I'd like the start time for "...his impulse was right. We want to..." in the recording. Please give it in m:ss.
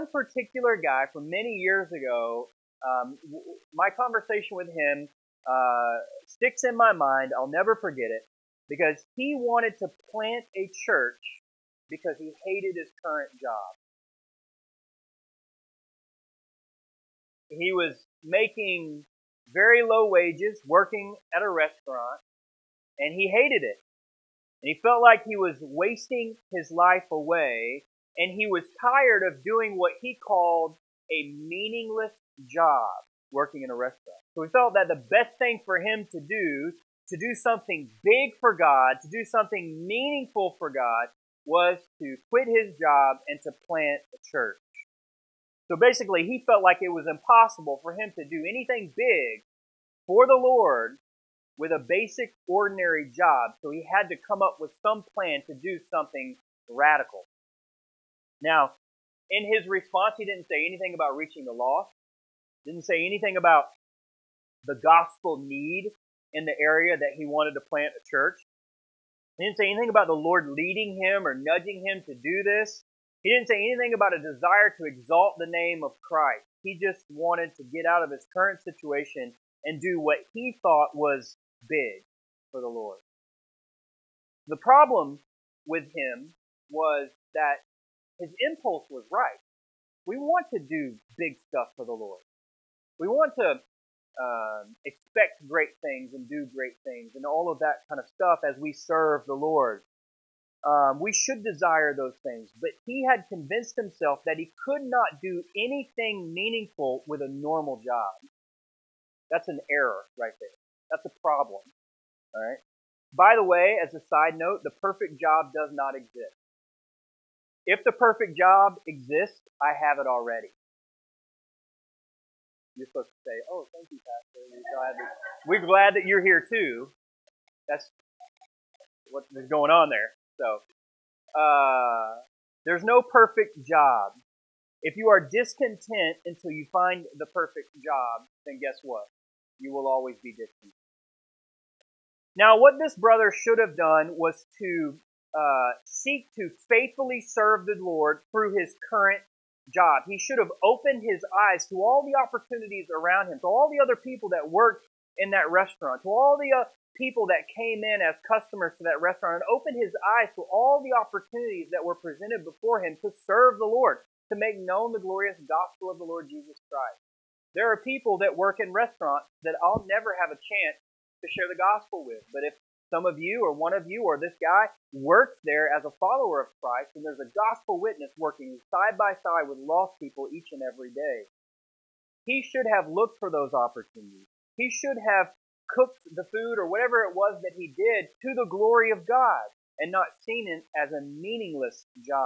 1:28.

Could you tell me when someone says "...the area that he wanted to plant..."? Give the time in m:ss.
1:06.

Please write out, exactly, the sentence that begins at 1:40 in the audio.
Um, we should desire those things, but he had convinced himself that he could not do anything meaningful with a normal job.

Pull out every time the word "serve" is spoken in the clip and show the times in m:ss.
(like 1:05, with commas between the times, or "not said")
1:38, 2:27, 2:43.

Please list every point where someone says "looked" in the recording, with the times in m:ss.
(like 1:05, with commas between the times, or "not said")
3:02.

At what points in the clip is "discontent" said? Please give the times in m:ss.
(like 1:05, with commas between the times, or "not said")
2:15, 2:20.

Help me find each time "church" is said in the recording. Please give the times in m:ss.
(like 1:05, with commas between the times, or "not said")
0:10, 0:44, 1:08.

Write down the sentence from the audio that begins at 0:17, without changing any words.
He was making very low wages, working at a restaurant, and he hated it.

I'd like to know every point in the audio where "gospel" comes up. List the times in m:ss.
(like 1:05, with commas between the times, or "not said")
1:04, 2:45, 2:51, 2:57.